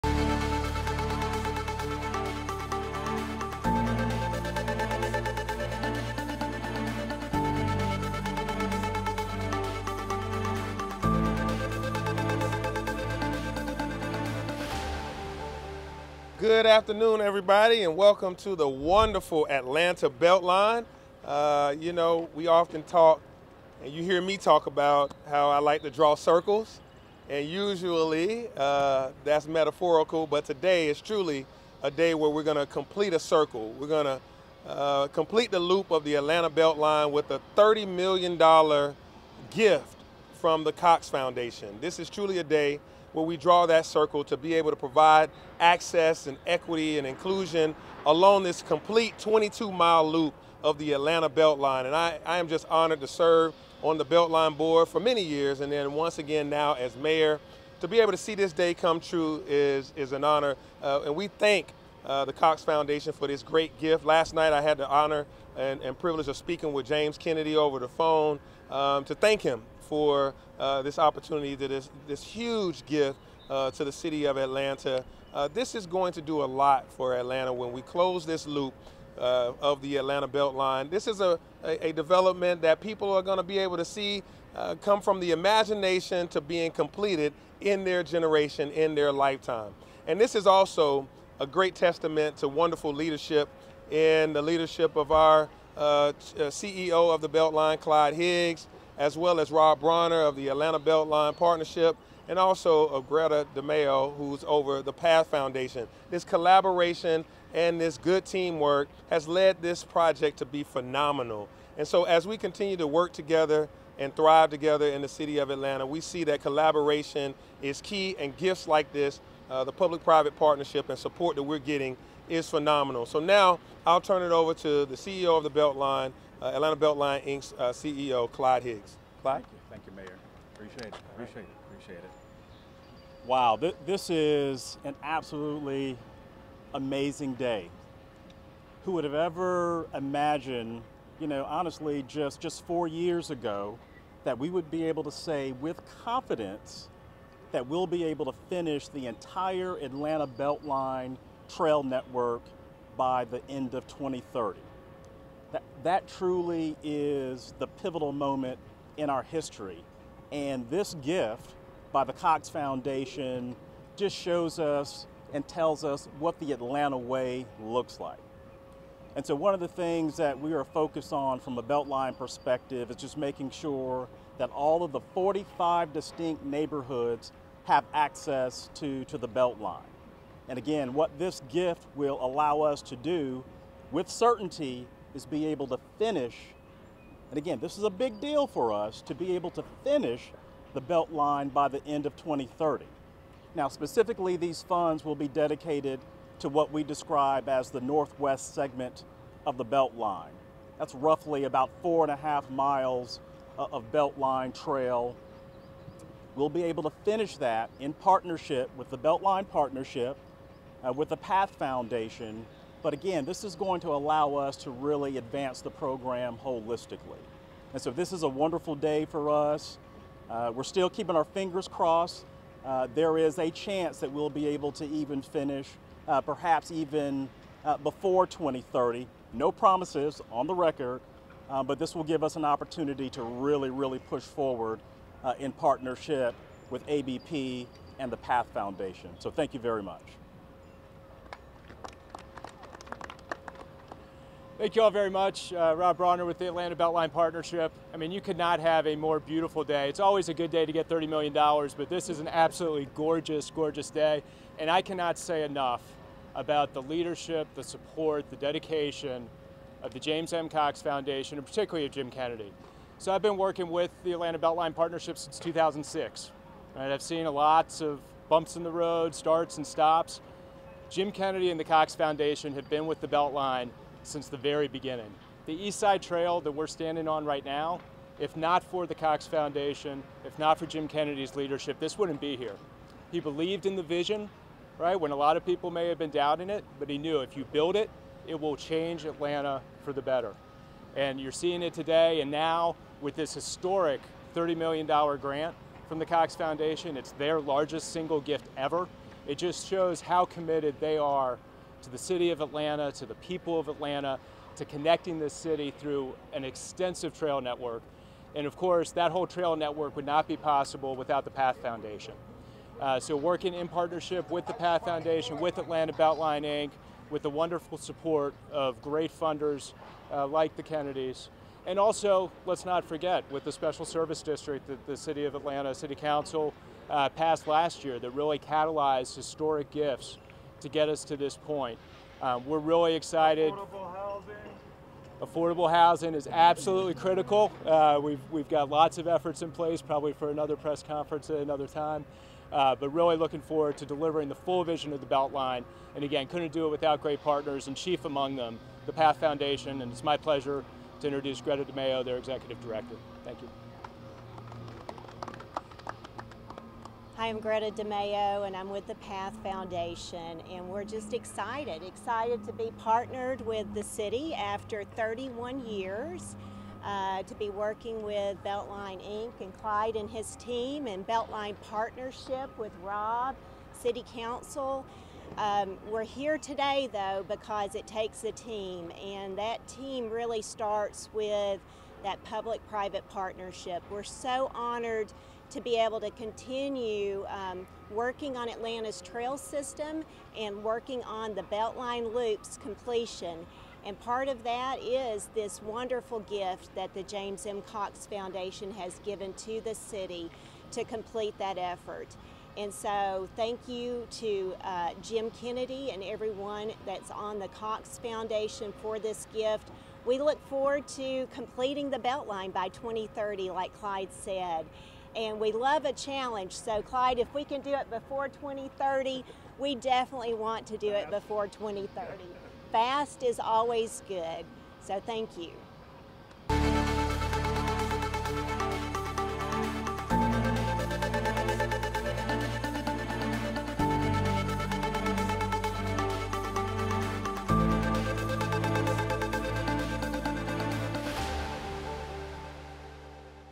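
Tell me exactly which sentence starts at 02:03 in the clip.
So now I'll turn it over to the CEO of the Beltline, uh, Atlanta Beltline Inc.'s uh, CEO, Clyde Higgs.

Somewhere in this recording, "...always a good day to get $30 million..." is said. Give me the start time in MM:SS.
04:09.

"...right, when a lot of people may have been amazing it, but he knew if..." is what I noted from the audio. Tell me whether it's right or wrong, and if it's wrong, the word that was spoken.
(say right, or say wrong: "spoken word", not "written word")
wrong: "doubting", not "amazing".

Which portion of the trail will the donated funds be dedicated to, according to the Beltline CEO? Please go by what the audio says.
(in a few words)
Northwest segment.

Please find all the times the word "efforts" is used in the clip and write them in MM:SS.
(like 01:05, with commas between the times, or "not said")
05:39, 06:41.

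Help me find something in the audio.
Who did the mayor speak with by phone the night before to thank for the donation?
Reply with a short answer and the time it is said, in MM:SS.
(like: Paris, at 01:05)
James Kennedy, at 01:06.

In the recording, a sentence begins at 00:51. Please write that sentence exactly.
And I, I am just honored to serve on the Beltline Board for many years and then once again now as mayor.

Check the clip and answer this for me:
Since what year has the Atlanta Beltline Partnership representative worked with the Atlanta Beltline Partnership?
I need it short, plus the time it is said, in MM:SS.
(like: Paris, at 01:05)
2006, at 04:25.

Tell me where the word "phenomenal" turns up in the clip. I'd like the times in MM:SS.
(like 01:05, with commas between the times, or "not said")
01:50, 02:02.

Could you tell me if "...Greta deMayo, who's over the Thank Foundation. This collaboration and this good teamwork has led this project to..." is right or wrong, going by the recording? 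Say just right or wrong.
wrong.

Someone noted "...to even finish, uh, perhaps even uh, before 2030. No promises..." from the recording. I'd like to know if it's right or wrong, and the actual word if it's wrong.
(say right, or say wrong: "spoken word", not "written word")
right.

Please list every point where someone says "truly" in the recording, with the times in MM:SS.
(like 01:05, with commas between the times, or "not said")
00:31, 00:42, 02:36.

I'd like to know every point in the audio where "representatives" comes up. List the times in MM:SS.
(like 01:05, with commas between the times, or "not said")
not said.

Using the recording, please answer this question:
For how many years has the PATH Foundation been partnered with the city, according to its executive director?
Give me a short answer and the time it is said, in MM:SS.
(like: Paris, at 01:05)
31 years, at 06:04.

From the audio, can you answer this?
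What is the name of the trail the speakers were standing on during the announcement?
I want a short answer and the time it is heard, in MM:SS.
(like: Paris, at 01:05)
East Side Trail, at 04:35.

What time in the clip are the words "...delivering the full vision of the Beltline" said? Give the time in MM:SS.
05:43.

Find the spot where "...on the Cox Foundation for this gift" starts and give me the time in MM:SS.
06:47.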